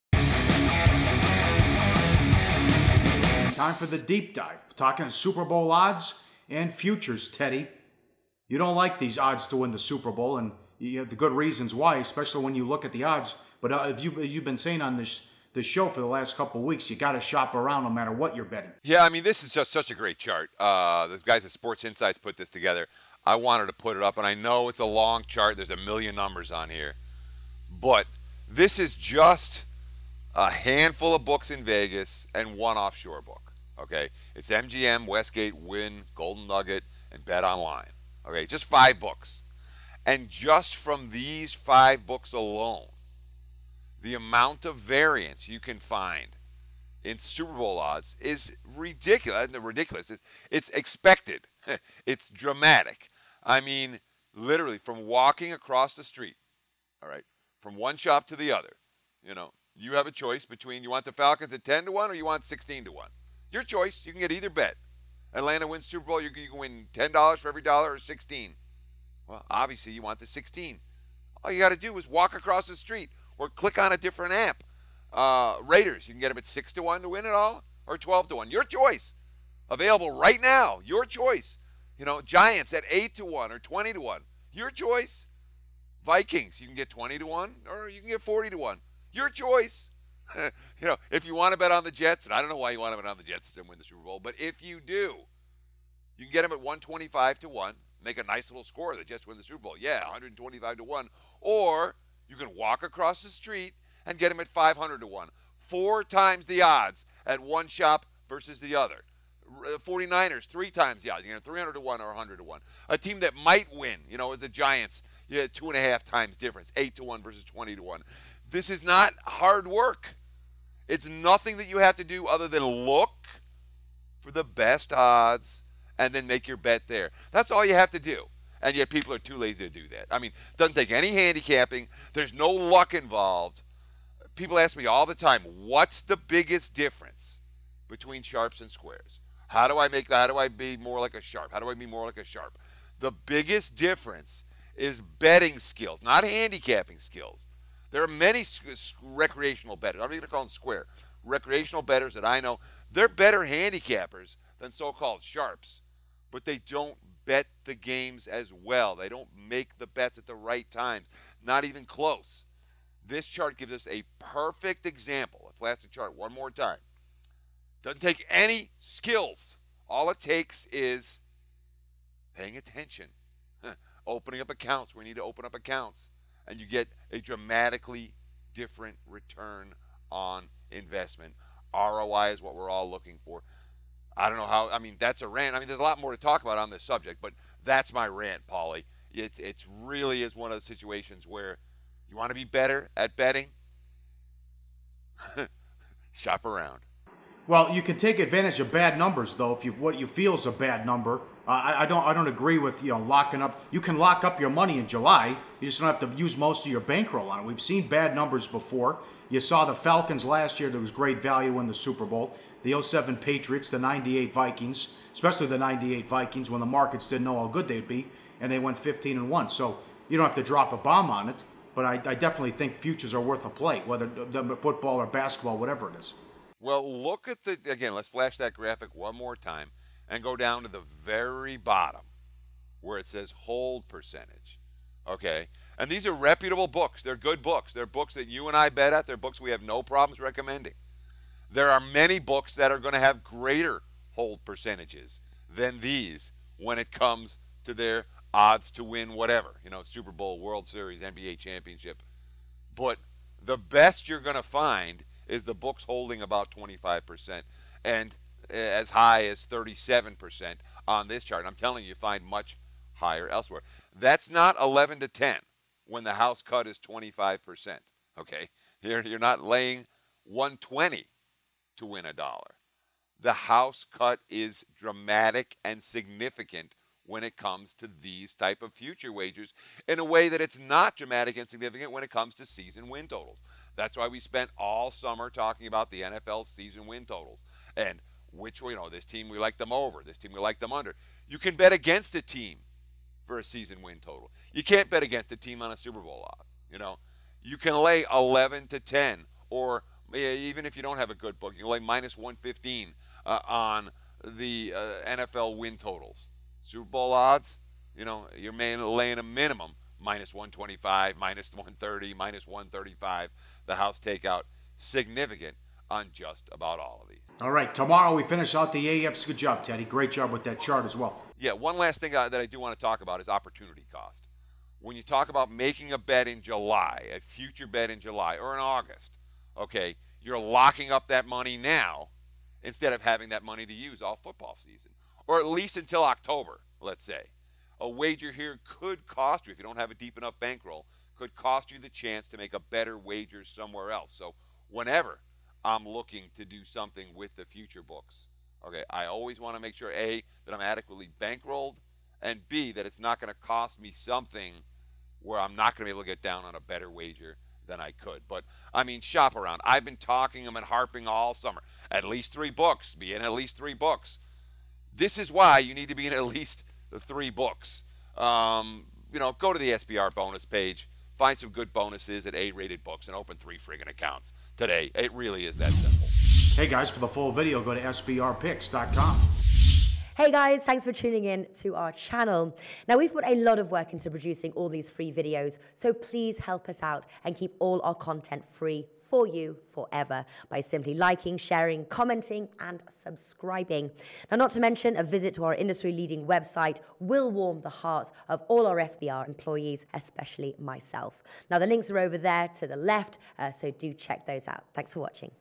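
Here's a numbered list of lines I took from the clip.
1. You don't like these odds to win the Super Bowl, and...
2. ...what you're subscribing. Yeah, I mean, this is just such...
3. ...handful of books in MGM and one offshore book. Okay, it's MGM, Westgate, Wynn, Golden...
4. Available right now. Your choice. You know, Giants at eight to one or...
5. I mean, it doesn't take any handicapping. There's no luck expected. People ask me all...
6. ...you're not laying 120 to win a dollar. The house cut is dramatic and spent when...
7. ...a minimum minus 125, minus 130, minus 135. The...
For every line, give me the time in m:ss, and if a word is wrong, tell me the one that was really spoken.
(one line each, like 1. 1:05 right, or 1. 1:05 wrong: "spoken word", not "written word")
1. 0:08 right
2. 0:18 wrong: "betting", not "subscribing"
3. 0:30 wrong: "Vegas", not "MGM"
4. 1:19 right
5. 2:10 wrong: "involved", not "expected"
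6. 4:28 wrong: "significant", not "spent"
7. 5:09 right.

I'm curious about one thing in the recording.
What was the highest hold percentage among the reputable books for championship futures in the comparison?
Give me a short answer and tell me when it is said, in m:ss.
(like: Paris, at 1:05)
37%, at 4:19.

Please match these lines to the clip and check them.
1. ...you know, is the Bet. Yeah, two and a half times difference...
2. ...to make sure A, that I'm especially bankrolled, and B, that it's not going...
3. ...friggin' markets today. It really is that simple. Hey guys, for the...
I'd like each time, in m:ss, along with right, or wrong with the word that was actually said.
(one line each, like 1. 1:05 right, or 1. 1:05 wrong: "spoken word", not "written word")
1. 1:54 wrong: "Giants", not "Bet"
2. 5:49 wrong: "adequately", not "especially"
3. 6:13 wrong: "accounts", not "markets".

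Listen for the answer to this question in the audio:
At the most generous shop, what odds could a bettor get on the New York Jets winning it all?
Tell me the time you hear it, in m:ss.
1:44.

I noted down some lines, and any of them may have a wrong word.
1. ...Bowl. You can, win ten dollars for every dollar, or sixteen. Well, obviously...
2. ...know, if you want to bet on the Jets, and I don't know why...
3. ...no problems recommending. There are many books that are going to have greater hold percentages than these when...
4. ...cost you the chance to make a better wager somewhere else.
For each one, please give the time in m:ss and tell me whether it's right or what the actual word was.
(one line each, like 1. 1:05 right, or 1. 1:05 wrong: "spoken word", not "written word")
1. 1:06 right
2. 1:30 right
3. 3:59 right
4. 5:41 right.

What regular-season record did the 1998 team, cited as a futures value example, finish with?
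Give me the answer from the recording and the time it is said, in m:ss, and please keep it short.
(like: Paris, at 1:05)
15 and 1, at 3:38.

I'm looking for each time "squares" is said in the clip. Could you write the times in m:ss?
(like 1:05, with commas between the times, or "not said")
2:18, 2:30.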